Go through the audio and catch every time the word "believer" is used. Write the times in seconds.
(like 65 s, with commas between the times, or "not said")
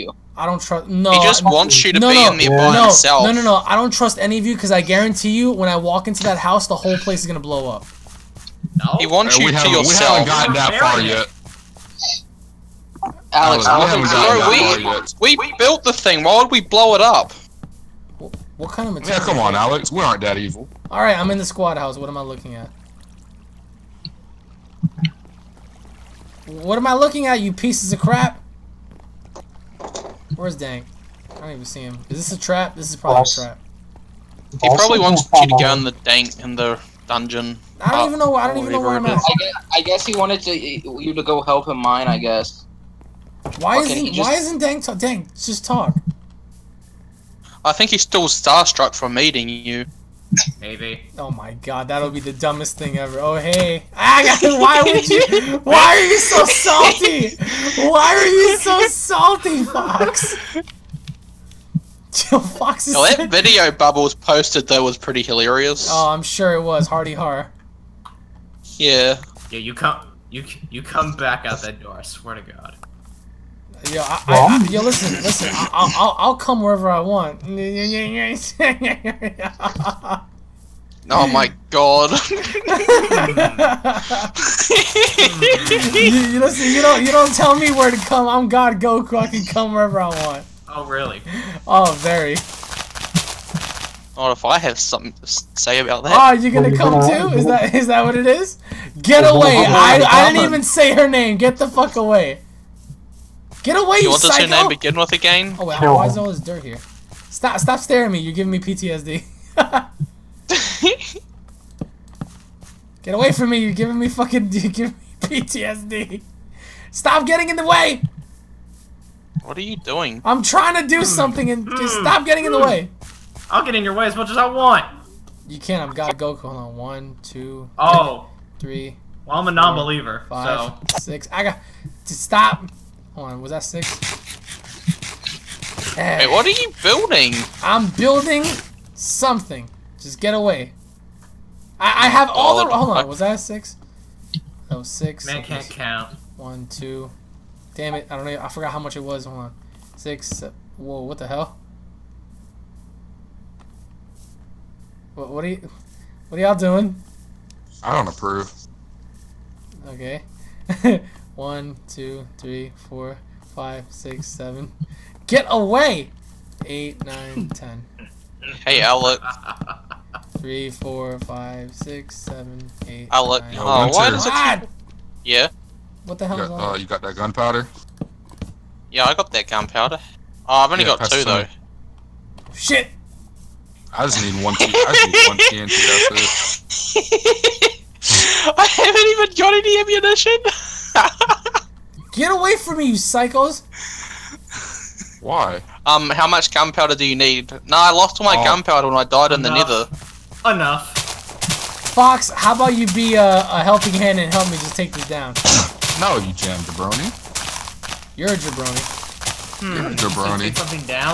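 129 s.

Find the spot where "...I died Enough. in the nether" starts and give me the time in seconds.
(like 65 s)
198 s.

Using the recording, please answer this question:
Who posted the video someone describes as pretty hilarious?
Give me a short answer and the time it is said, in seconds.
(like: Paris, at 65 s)
Bubbles, at 63 s.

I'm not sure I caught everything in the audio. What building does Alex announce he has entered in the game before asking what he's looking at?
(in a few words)
squad house.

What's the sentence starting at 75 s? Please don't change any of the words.
I, will I'll come wherever I want.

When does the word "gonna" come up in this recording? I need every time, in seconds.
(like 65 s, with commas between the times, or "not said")
7 s, 96 s.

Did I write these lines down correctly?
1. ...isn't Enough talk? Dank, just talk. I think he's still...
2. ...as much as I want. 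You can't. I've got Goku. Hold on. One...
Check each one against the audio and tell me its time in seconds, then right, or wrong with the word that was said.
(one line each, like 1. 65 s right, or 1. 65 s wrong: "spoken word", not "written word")
1. 44 s wrong: "Dank", not "Enough"
2. 124 s right.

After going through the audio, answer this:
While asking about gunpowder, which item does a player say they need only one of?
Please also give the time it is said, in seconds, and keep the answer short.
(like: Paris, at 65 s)
TNT, at 185 s.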